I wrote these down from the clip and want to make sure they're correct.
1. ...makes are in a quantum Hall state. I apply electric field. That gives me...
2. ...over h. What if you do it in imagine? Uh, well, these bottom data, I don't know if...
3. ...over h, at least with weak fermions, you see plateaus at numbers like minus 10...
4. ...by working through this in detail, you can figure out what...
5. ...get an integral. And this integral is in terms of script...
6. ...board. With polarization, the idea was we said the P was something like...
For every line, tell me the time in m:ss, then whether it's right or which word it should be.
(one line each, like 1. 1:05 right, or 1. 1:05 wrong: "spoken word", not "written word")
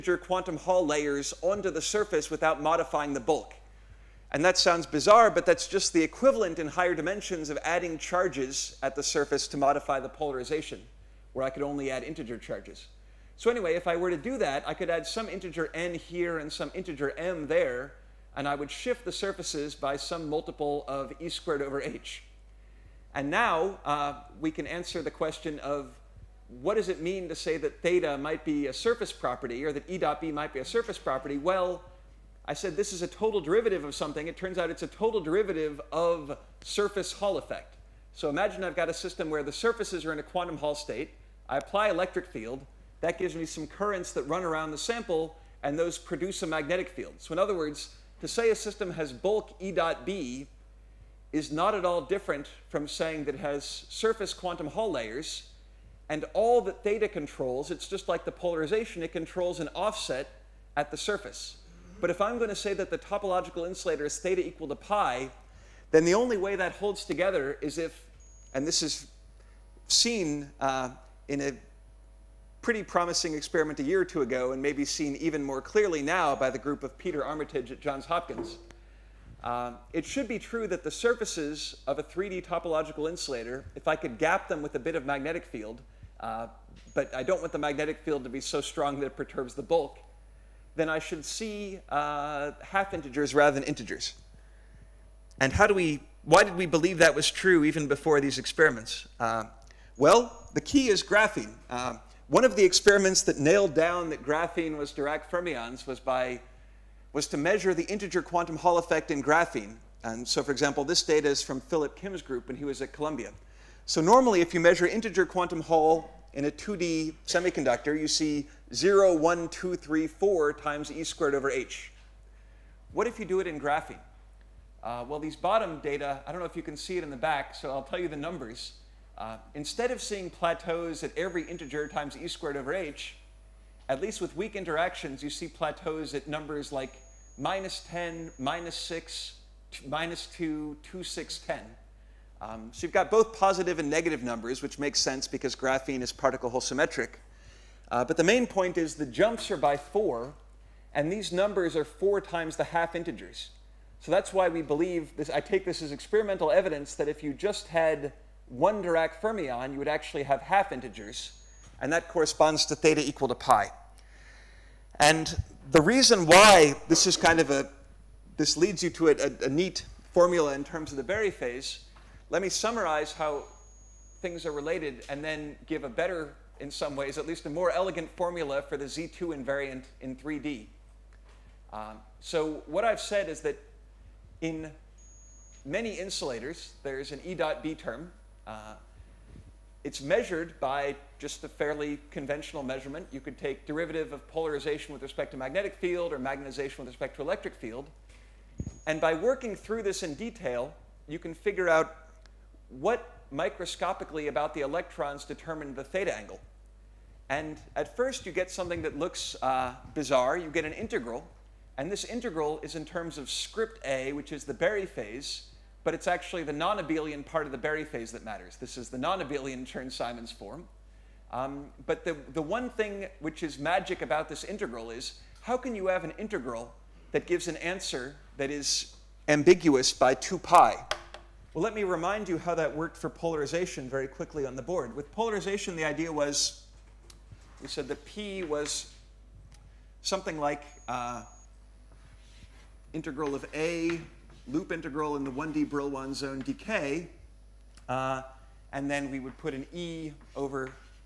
1. 0:39 wrong: "surfaces", not "makes"
2. 2:01 wrong: "graphene", not "imagine"
3. 2:12 wrong: "interactions", not "fermions"
4. 3:18 right
5. 3:30 right
6. 3:54 right.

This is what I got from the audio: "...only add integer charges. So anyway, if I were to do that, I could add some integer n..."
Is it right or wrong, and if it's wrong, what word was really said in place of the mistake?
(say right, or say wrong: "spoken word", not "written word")
right.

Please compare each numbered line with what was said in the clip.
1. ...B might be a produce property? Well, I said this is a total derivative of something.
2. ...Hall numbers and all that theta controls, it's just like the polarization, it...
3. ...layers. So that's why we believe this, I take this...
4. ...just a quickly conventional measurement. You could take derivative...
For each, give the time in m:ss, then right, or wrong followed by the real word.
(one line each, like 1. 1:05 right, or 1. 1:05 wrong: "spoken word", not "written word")
1. 0:30 wrong: "surface", not "produce"
2. 0:54 wrong: "layers", not "numbers"
3. 2:32 wrong: "integers", not "layers"
4. 3:11 wrong: "fairly", not "quickly".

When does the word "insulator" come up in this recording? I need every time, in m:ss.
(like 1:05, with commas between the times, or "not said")
1:03, 1:23, 3:05.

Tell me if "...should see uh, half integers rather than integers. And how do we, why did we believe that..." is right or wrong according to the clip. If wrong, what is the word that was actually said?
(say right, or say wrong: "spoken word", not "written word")
right.